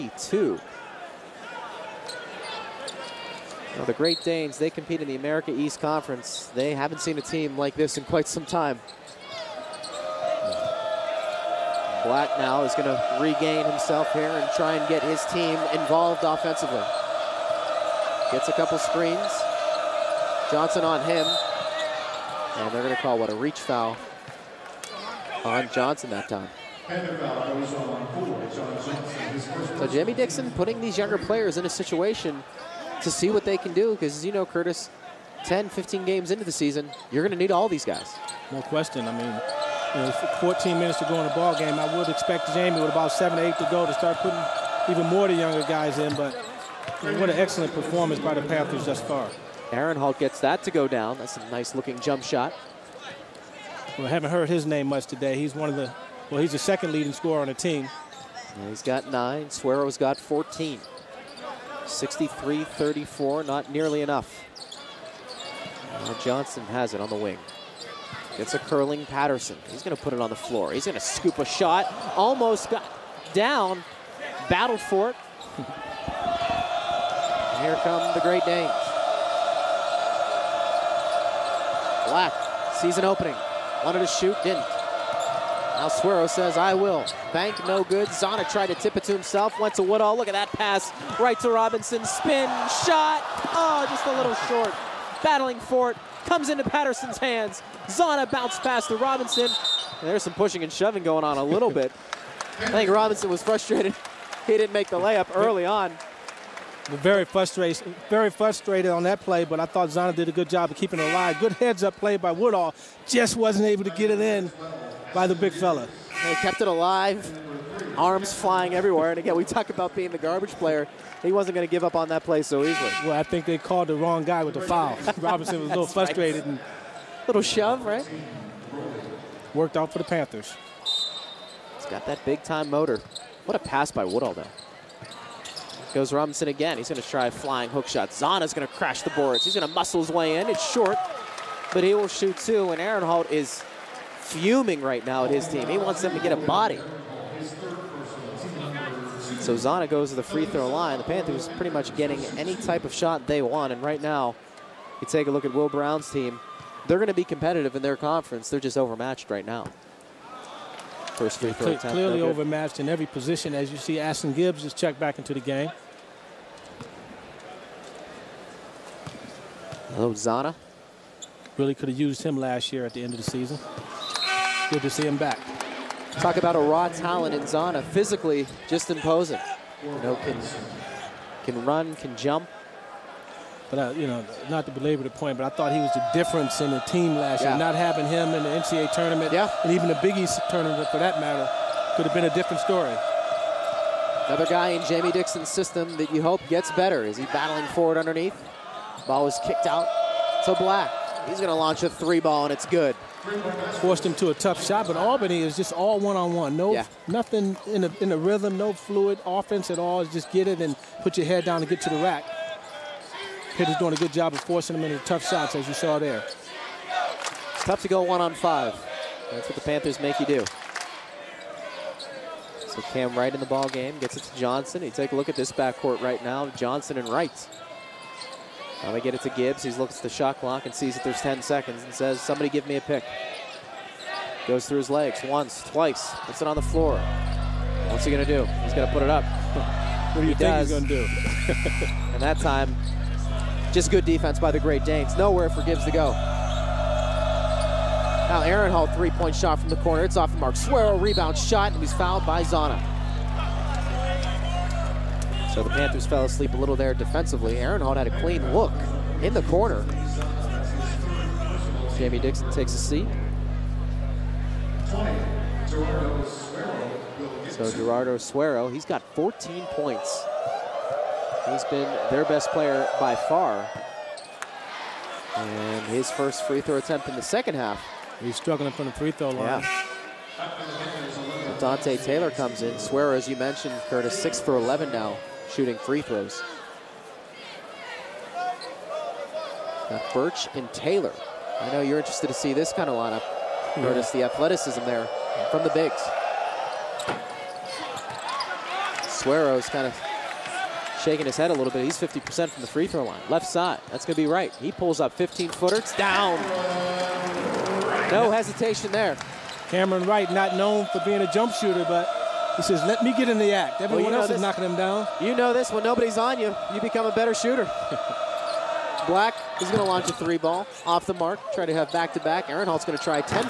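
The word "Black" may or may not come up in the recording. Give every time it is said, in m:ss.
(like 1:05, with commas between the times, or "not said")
0:12, 1:22, 3:20, 5:19.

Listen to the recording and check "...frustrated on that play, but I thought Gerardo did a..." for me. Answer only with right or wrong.
wrong.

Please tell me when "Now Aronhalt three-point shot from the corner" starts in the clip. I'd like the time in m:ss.
4:08.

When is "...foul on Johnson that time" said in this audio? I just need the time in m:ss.
0:23.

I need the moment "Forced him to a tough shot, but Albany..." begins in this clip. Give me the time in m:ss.
3:23.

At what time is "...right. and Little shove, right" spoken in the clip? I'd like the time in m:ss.
2:06.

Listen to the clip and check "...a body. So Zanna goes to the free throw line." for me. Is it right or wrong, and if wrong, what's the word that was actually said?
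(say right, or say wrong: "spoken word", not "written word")
right.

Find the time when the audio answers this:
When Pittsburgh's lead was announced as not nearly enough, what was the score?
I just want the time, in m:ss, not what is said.
1:01.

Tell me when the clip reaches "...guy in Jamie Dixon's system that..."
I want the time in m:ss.
3:14.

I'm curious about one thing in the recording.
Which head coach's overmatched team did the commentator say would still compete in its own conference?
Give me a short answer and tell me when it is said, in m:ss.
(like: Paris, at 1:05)
Will Brown, at 2:35.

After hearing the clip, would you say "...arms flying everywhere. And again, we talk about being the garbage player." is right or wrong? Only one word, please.
right.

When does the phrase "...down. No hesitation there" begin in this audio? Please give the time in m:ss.
5:05.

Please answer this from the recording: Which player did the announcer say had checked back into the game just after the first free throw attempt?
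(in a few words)
Ashton Gibbs.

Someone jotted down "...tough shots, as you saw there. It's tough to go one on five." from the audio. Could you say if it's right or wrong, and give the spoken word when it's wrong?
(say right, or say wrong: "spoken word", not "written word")
right.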